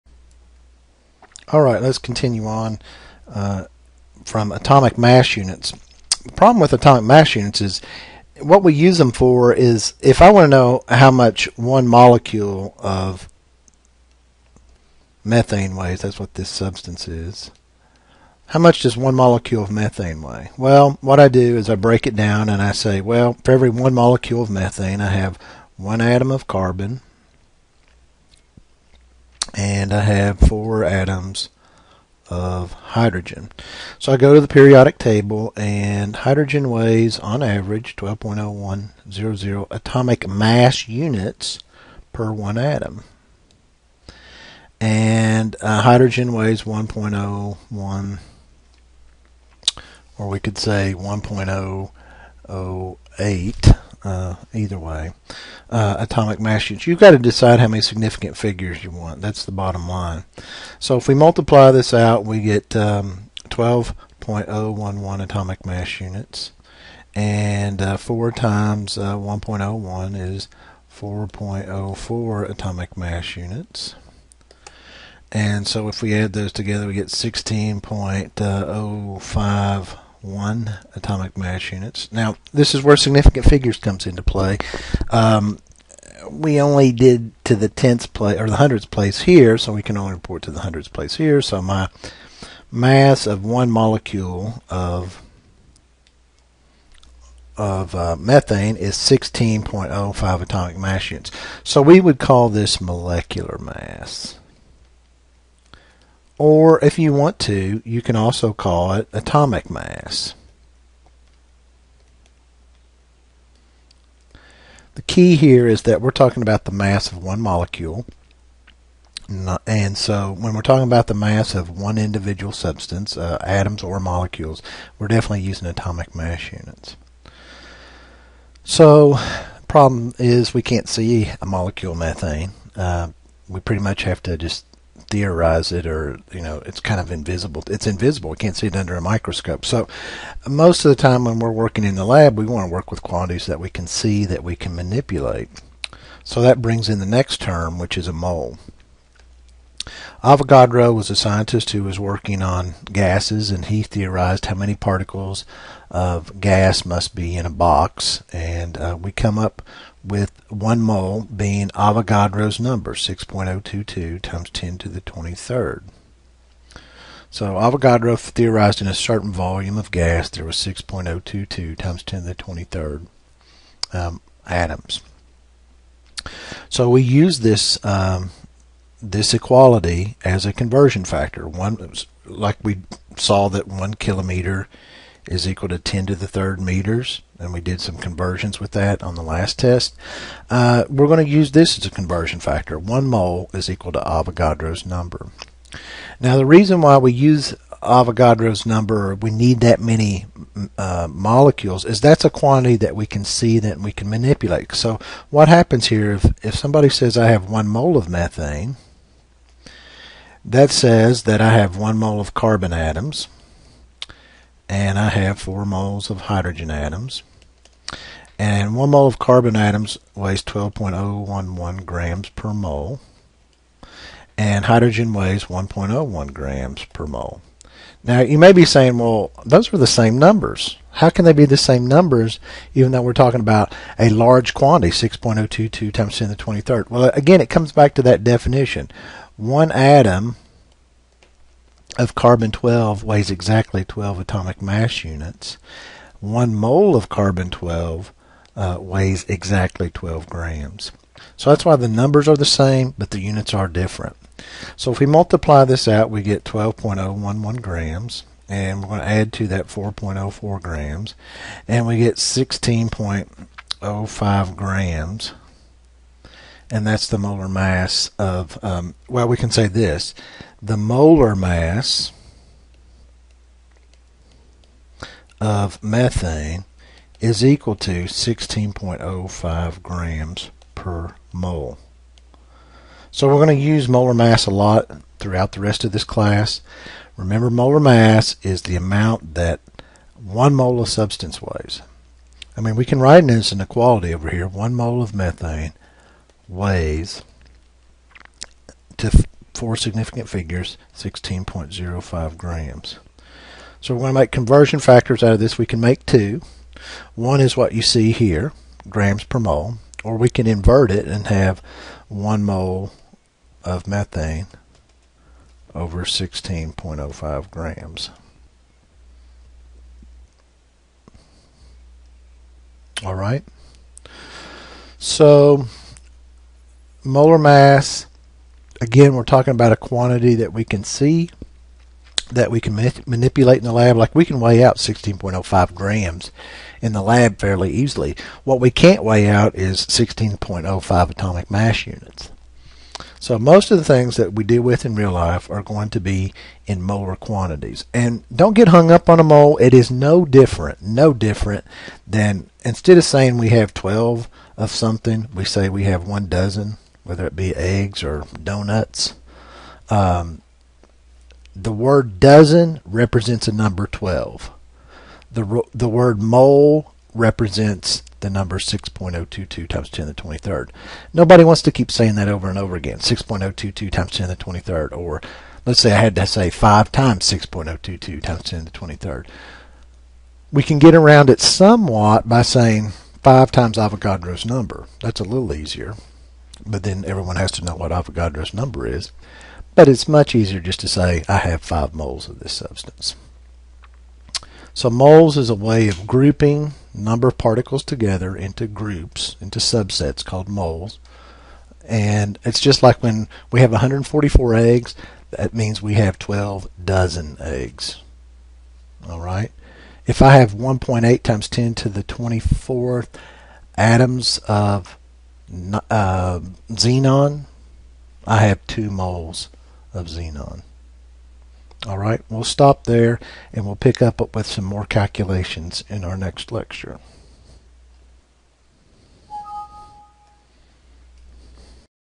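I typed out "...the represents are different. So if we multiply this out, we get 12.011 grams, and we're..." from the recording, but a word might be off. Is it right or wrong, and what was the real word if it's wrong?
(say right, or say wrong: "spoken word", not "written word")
wrong: "units", not "represents".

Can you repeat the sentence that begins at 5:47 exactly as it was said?
And don't get hung up on a mole.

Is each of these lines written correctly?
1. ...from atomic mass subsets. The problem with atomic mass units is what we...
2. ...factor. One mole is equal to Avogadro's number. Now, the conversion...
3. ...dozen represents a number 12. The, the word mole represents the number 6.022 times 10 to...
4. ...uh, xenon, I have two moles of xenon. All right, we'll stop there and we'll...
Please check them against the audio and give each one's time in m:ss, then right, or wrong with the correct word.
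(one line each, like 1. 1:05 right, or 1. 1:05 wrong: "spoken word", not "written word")
1. 0:04 wrong: "units", not "subsets"
2. 3:12 wrong: "reason", not "conversion"
3. 6:02 right
4. 6:55 right.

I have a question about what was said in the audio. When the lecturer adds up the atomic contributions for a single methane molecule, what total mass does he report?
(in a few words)
16.05 atomic mass units.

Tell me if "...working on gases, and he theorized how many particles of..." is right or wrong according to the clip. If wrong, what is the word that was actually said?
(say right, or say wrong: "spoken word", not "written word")
right.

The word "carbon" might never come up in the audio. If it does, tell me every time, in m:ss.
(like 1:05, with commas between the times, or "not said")
0:26, 3:32, 3:39, 4:02, 4:07.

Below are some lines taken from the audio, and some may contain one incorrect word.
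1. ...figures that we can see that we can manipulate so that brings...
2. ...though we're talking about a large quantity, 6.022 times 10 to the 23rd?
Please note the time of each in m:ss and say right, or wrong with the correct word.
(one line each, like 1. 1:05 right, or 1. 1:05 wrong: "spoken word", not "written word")
1. 2:23 wrong: "quantities", not "figures"
2. 3:52 right.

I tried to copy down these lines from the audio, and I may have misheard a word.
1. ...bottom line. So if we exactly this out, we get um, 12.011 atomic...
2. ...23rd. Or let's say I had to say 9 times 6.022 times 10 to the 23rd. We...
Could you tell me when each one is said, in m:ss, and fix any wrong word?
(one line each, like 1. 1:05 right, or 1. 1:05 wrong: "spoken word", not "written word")
1. 0:59 wrong: "multiply", not "exactly"
2. 6:14 wrong: "5", not "9".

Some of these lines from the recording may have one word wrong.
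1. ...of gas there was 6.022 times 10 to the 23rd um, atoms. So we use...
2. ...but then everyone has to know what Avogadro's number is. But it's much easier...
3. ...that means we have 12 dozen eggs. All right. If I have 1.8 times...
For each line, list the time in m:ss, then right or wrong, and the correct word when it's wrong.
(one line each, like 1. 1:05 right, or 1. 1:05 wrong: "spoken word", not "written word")
1. 2:49 right
2. 6:26 right
3. 6:45 right.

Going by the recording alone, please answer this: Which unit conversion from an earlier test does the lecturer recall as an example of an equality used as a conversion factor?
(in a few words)
1 kilometer = 10^3 meters.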